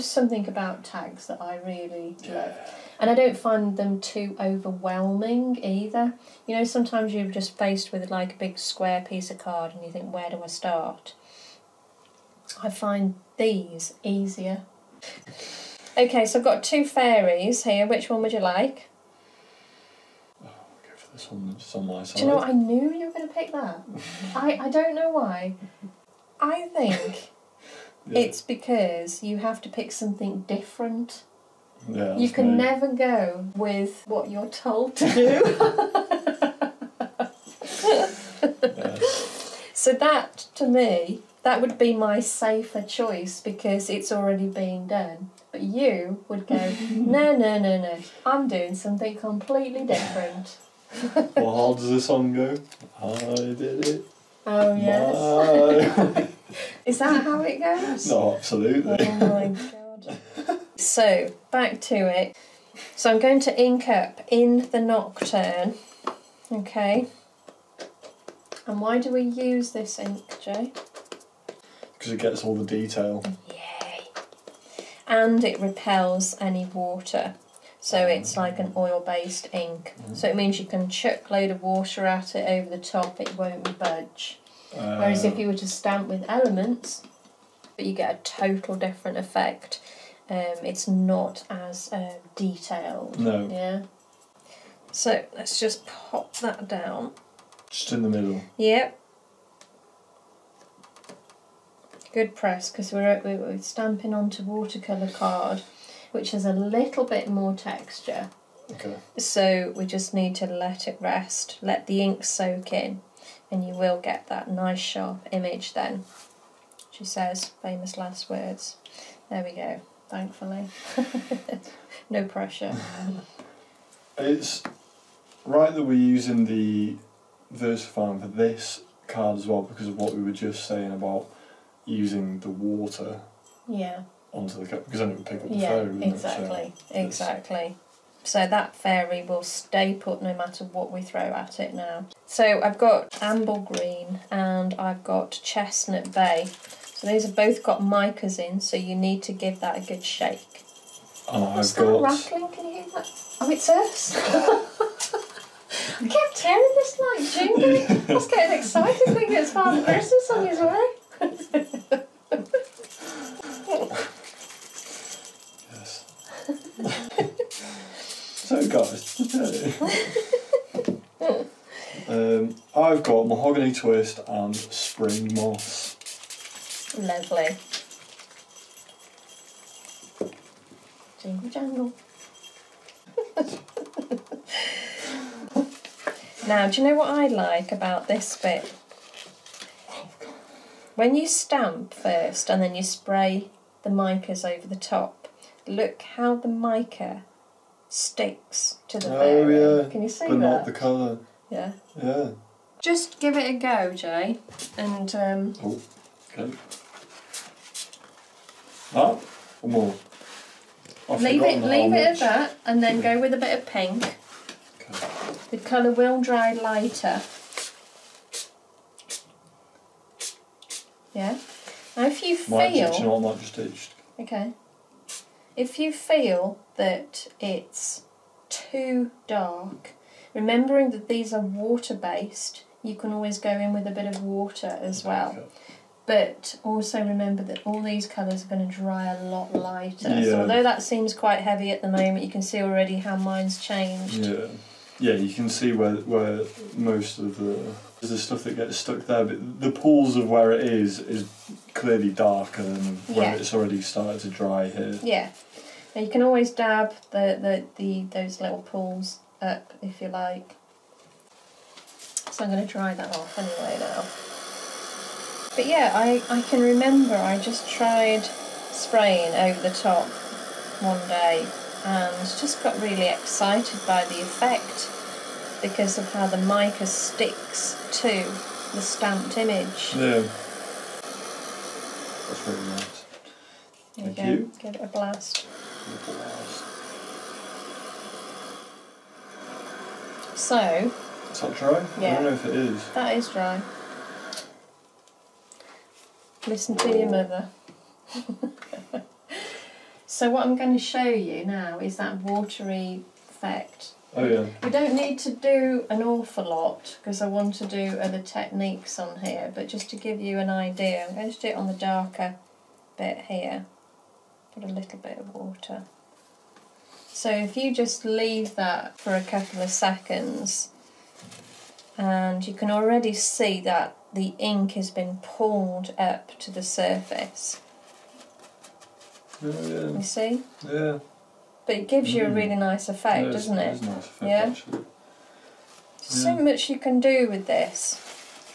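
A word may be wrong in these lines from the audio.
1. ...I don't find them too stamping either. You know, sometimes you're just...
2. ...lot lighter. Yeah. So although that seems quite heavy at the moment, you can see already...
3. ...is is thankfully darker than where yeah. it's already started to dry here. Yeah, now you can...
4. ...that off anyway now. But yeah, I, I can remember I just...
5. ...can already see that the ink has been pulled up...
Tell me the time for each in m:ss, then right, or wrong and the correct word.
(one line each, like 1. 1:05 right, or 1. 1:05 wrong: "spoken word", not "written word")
1. 0:03 wrong: "overwhelming", not "stamping"
2. 3:59 right
3. 4:10 wrong: "clearly", not "thankfully"
4. 4:22 right
5. 5:22 right.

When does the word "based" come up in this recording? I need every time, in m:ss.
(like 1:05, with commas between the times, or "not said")
1:18, 3:51.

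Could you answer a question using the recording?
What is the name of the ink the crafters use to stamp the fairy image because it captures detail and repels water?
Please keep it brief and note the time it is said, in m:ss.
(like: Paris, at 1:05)
Nocturne, at 1:04.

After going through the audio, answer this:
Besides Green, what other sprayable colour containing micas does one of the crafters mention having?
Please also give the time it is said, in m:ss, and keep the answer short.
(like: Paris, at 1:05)
Chestnut Bay, at 2:25.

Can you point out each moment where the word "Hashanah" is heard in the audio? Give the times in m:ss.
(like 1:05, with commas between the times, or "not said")
not said.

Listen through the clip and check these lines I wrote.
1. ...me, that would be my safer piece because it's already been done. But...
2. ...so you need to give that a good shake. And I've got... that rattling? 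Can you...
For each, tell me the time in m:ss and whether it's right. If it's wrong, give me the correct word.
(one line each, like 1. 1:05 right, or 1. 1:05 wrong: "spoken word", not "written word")
1. 0:40 wrong: "choice", not "piece"
2. 2:28 right.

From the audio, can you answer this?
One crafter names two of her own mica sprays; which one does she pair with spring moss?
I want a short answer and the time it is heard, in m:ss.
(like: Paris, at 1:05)
Mahogany twist, at 2:53.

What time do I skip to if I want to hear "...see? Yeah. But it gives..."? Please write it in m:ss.
5:30.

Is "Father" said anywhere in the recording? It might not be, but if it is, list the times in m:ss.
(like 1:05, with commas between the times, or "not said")
2:39.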